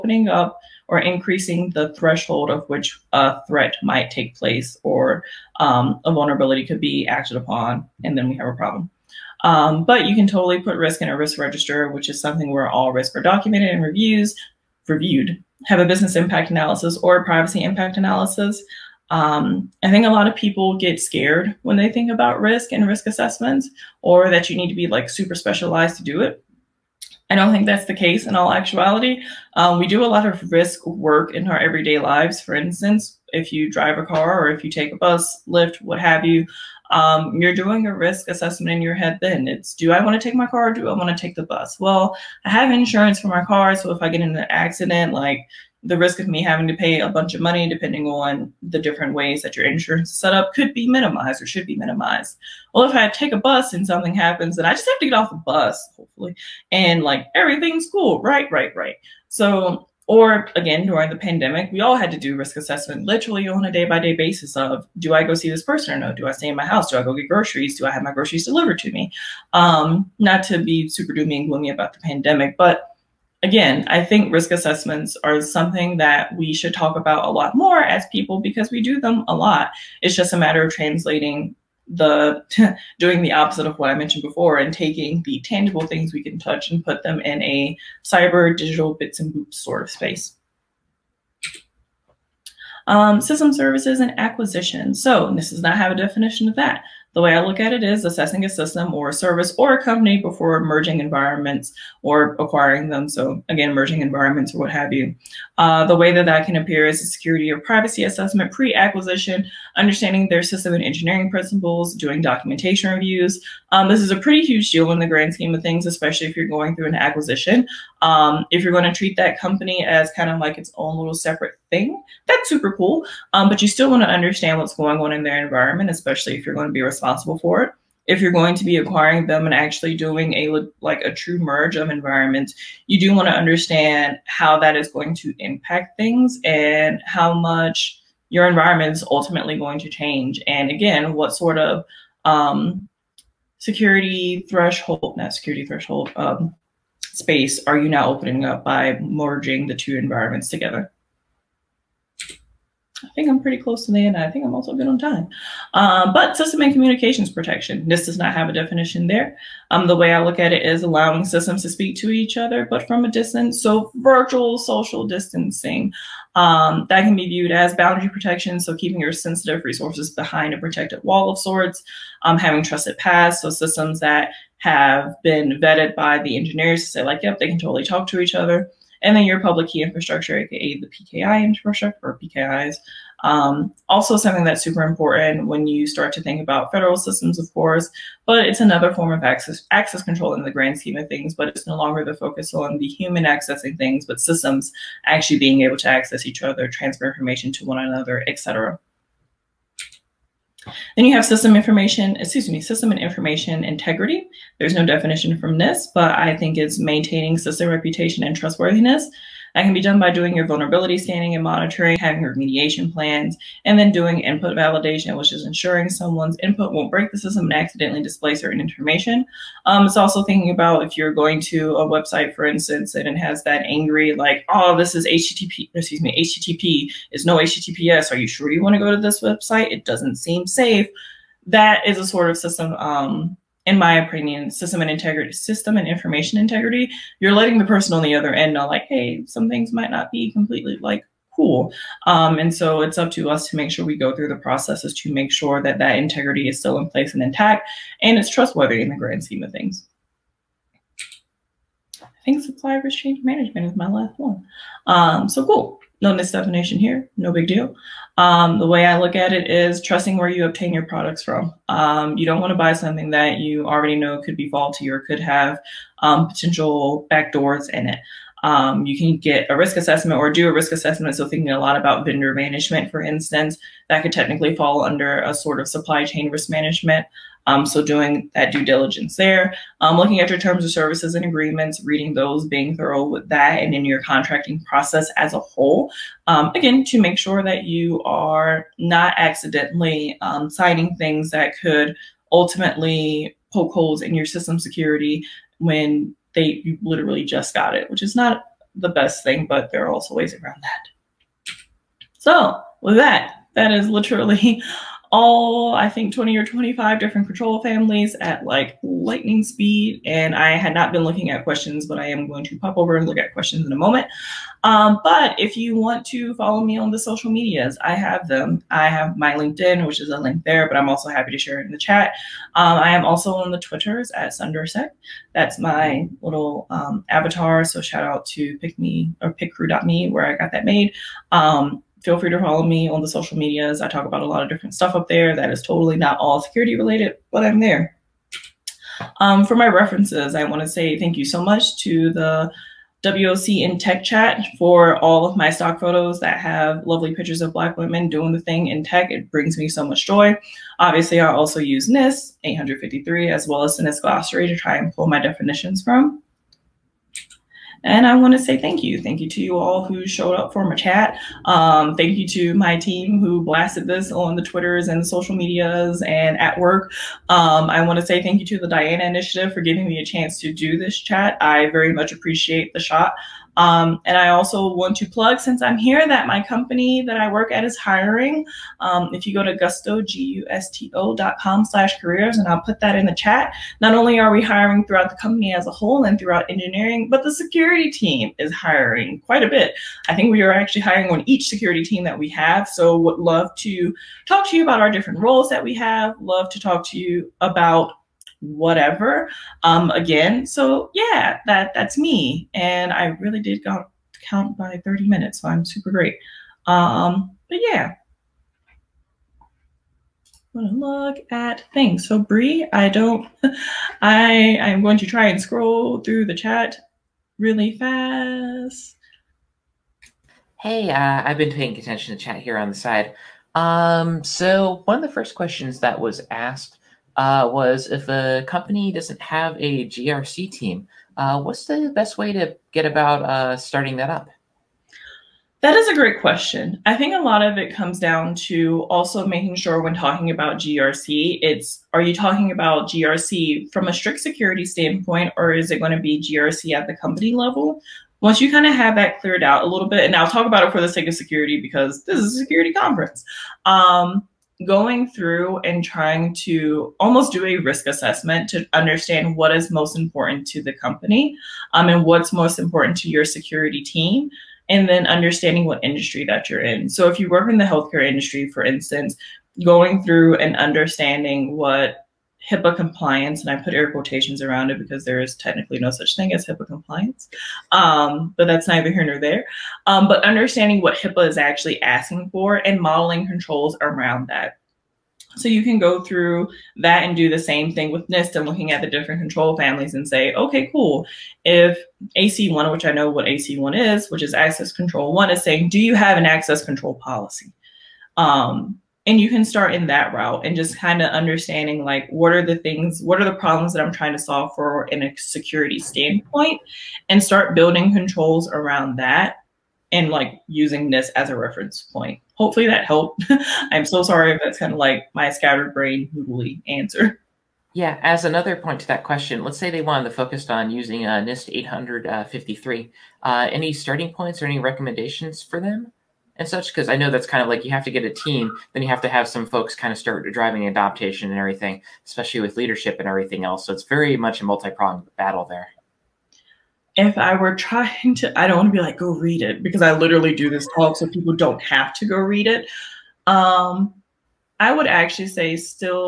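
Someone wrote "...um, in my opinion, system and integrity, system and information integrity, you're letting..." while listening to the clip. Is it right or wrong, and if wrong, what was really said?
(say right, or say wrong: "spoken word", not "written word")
right.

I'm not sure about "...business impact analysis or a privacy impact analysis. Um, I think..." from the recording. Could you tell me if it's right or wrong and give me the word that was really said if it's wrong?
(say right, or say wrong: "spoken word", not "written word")
right.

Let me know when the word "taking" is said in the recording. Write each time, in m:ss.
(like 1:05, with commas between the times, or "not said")
1:24.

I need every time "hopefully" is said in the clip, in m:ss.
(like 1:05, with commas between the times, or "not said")
0:55, 8:32.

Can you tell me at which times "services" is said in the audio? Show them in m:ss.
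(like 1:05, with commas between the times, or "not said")
1:33, 1:39, 4:40.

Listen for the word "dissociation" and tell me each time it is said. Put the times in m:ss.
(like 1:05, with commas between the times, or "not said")
not said.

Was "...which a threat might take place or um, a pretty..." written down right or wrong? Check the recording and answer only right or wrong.
wrong.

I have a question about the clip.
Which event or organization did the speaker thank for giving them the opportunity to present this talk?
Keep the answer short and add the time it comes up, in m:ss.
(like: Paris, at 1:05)
the Diana Initiative, at 6:08.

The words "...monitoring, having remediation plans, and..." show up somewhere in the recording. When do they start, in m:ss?
3:31.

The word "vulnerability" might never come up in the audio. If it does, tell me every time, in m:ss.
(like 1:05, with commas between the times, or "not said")
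0:06, 3:30.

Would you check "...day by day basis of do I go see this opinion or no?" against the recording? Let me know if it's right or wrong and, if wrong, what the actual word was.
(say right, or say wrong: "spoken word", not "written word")
wrong: "person", not "opinion".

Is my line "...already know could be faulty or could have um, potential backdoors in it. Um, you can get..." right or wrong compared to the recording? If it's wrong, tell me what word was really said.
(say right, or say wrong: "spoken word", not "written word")
right.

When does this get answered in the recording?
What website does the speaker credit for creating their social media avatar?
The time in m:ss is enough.
5:29.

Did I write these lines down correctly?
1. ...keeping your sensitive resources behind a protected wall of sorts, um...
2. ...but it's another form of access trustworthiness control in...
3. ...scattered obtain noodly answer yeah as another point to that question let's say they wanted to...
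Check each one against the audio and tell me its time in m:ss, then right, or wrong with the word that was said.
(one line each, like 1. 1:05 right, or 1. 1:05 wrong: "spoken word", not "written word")
1. 2:48 right
2. 3:08 wrong: "access", not "trustworthiness"
3. 8:35 wrong: "brain", not "obtain".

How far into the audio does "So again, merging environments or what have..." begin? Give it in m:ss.
1:43.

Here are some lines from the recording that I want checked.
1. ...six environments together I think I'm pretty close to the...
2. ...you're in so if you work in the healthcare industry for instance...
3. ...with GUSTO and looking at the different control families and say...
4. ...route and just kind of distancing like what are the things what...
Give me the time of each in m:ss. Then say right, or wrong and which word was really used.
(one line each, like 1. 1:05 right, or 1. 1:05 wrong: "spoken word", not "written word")
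1. 2:29 wrong: "two", not "six"
2. 7:46 right
3. 8:07 wrong: "NIST", not "GUSTO"
4. 8:20 wrong: "understanding", not "distancing".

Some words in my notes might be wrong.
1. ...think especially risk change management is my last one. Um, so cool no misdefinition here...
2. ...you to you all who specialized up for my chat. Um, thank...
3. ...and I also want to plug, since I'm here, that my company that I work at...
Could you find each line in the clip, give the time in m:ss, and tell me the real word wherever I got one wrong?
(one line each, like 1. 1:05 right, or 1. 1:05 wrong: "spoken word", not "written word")
1. 4:12 wrong: "supply", not "especially"
2. 5:59 wrong: "showed", not "specialized"
3. 6:14 right.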